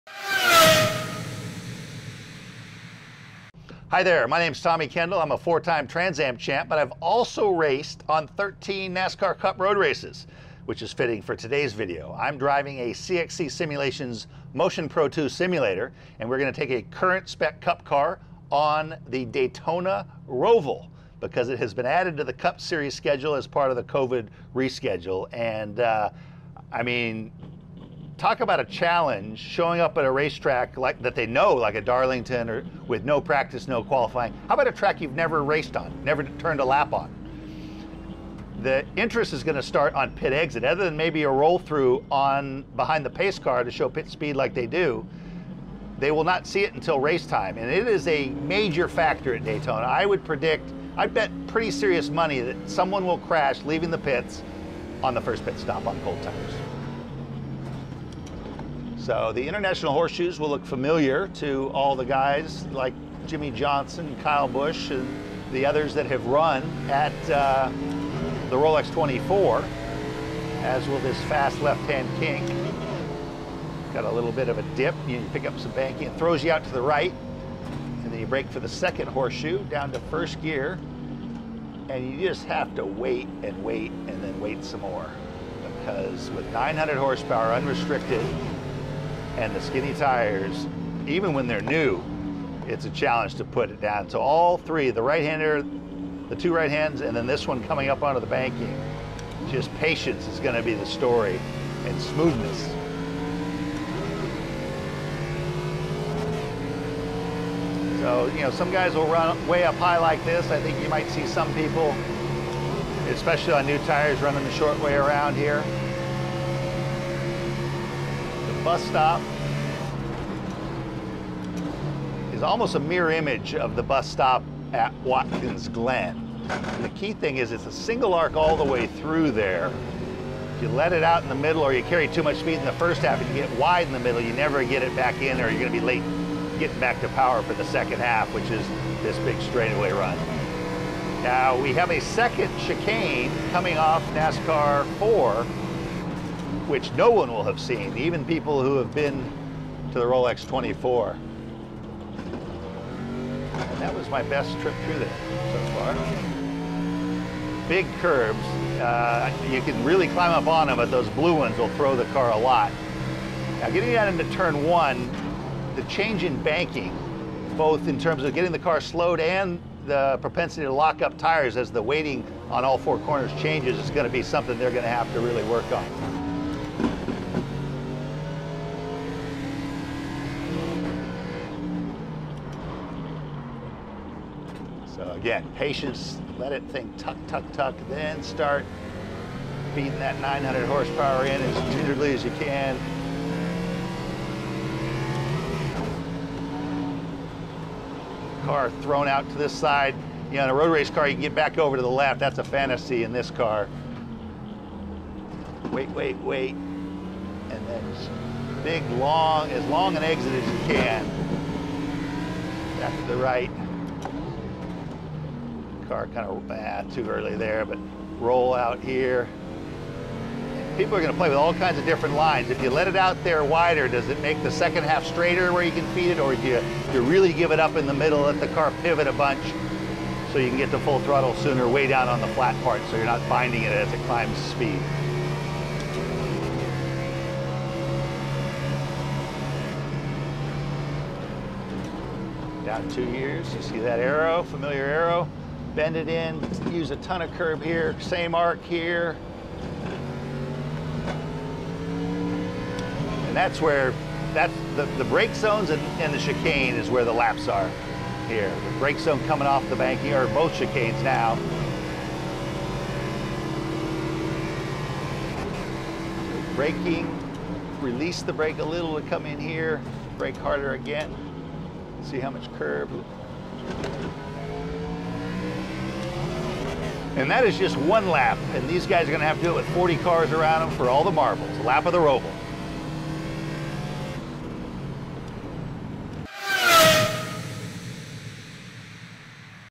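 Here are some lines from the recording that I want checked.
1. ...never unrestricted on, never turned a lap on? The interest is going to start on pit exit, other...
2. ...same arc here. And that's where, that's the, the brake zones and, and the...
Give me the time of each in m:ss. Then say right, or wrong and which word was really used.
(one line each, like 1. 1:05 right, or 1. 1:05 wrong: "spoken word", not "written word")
1. 0:35 wrong: "raced", not "unrestricted"
2. 4:07 right.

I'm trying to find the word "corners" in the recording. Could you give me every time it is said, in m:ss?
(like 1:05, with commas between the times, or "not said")
2:52.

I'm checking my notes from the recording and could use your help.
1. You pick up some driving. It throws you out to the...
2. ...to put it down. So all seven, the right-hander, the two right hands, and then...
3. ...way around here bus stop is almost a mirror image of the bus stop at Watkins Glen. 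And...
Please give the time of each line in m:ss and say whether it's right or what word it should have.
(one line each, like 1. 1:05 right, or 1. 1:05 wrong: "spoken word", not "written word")
1. 1:15 wrong: "banking", not "driving"
2. 1:33 wrong: "three", not "seven"
3. 1:54 right.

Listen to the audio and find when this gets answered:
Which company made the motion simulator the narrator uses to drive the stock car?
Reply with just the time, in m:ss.
0:12.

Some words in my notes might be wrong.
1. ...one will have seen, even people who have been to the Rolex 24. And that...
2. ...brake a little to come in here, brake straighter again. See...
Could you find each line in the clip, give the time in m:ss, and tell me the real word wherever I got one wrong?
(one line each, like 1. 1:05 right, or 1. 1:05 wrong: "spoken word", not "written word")
1. 2:27 right
2. 4:28 wrong: "harder", not "straighter".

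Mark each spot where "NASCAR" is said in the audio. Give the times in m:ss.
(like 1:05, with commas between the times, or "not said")
0:08, 2:24.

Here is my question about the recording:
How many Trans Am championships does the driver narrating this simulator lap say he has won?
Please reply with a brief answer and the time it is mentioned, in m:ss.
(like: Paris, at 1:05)
4, at 0:05.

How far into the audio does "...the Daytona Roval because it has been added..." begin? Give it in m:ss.
0:19.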